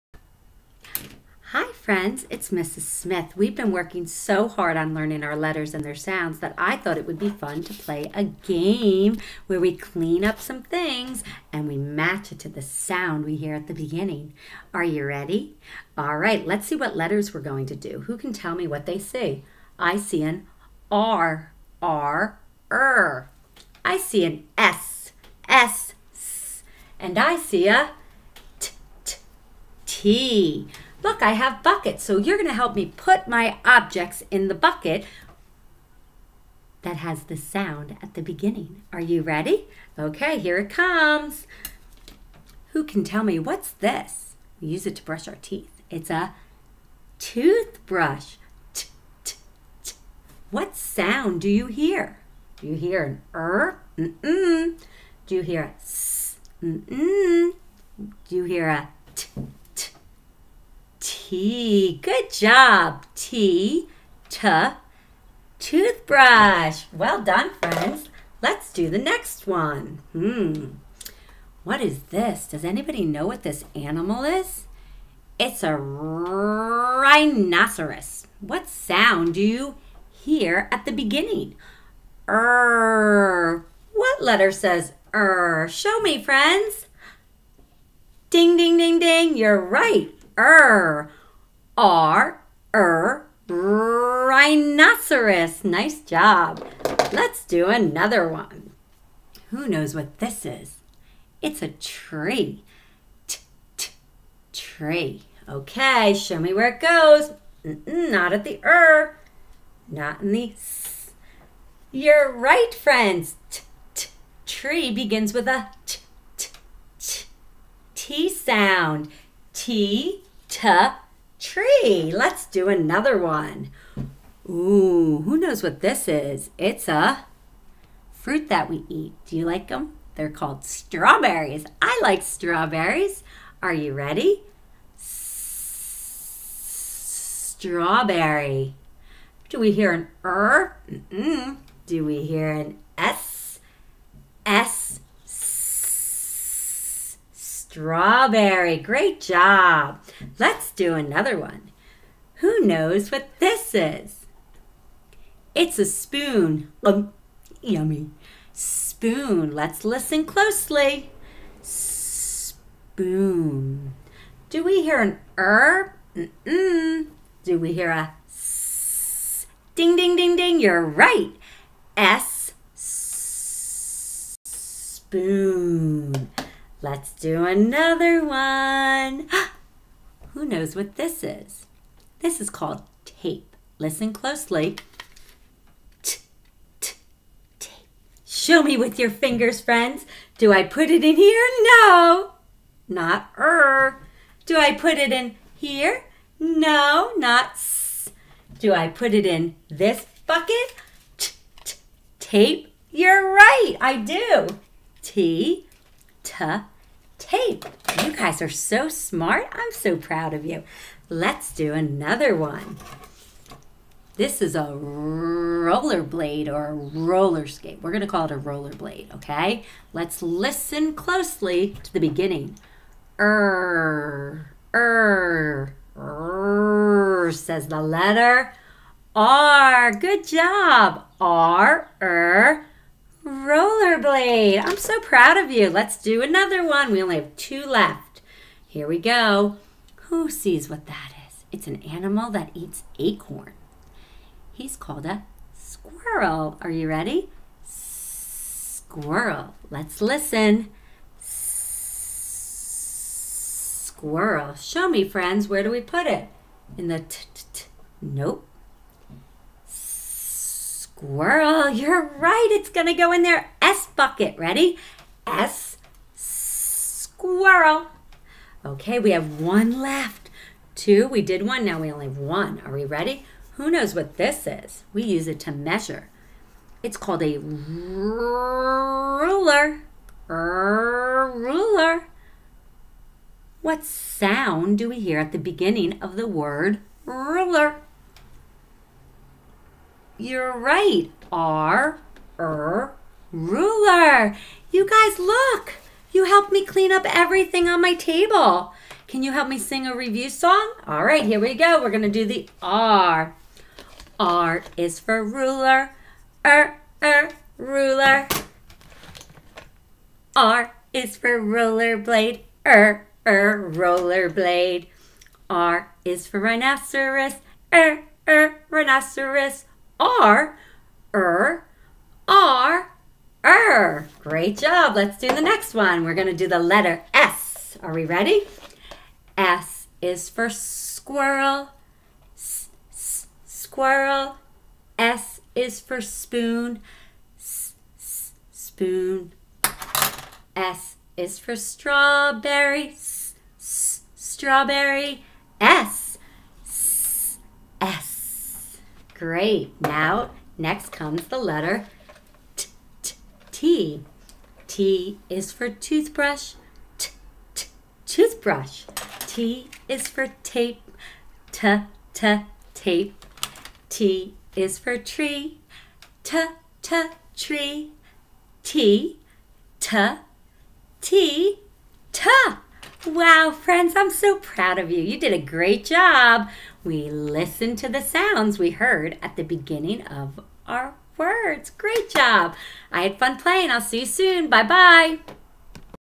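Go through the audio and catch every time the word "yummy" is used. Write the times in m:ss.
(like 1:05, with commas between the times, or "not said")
2:37.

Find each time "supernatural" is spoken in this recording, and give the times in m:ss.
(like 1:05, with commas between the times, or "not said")
not said.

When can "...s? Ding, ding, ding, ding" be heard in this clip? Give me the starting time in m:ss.
2:48.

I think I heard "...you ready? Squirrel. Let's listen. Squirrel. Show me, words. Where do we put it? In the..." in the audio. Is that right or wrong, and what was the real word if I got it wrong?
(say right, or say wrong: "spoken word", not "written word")
wrong: "friends", not "words".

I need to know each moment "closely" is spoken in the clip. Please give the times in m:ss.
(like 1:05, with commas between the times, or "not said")
2:40, 3:04, 3:40.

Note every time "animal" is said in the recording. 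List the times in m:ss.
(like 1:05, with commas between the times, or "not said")
1:13, 4:01.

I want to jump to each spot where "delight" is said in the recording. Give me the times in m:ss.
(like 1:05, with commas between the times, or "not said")
not said.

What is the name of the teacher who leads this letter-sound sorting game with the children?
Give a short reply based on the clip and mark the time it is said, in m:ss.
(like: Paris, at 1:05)
Mrs. Smith, at 0:02.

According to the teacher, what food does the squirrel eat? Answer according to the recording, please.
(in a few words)
Acorn.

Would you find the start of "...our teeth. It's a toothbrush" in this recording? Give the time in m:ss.
0:45.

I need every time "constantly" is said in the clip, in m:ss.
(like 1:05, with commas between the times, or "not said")
not said.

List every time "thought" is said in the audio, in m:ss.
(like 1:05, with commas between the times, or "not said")
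0:06.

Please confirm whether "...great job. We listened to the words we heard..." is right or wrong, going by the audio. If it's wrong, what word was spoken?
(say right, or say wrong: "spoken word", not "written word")
wrong: "sounds", not "words".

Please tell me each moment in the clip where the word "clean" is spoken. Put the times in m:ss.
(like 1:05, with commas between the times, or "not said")
0:09, 4:56.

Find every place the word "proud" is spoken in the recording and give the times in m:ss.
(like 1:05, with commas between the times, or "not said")
3:29, 3:55, 6:14.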